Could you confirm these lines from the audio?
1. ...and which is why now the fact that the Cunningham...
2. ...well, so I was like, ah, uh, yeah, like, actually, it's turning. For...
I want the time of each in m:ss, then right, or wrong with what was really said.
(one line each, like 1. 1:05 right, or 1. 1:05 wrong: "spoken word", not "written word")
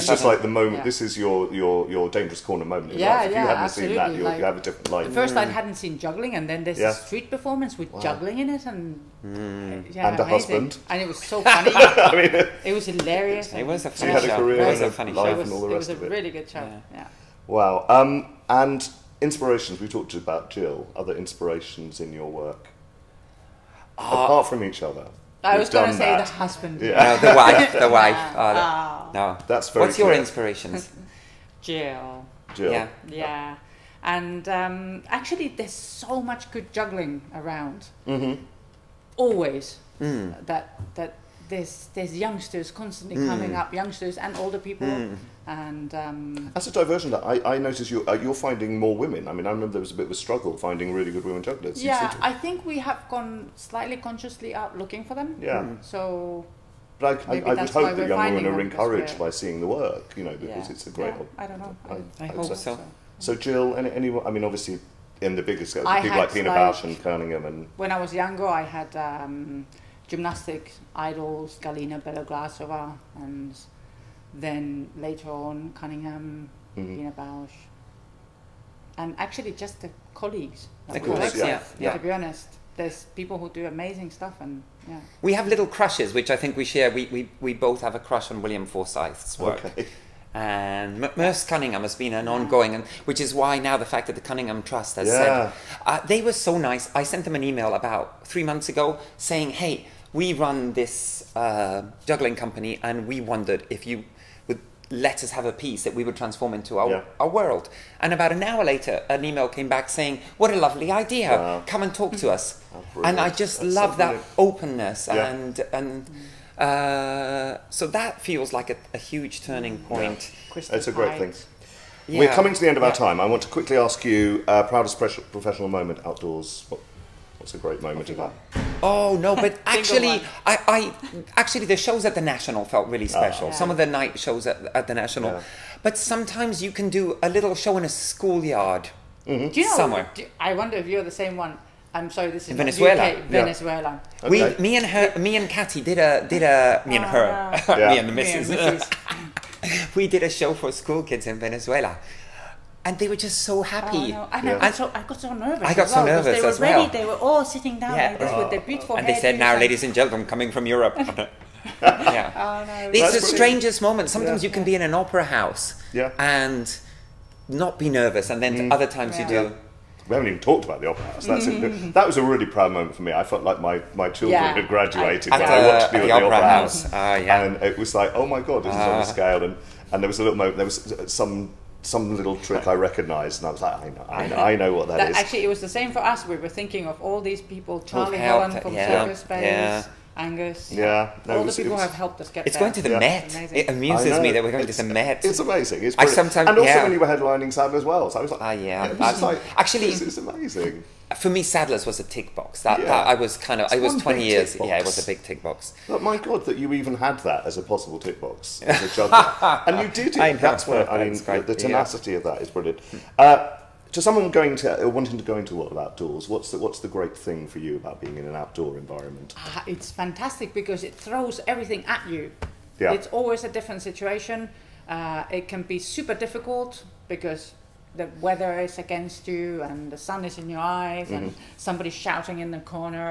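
1. 1:32 right
2. 3:17 wrong: "amazing", not "turning".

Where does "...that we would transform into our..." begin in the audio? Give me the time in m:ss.
1:45.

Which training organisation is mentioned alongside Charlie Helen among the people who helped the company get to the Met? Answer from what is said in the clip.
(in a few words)
Circus Space.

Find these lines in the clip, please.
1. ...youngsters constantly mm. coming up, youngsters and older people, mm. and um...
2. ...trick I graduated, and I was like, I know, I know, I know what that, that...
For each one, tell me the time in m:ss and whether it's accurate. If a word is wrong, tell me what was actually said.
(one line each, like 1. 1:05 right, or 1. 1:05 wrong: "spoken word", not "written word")
1. 0:42 right
2. 3:02 wrong: "recognised", not "graduated".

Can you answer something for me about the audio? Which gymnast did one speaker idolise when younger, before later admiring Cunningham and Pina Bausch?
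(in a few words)
Galina Beloglazova.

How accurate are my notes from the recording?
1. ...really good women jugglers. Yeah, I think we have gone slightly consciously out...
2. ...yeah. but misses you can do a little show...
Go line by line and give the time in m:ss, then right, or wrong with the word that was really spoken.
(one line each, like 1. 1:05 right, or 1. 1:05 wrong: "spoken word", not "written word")
1. 0:50 right
2. 2:15 wrong: "sometimes", not "misses".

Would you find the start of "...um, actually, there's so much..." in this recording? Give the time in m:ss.
0:34.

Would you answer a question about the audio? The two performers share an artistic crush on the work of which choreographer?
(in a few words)
William Forsyth.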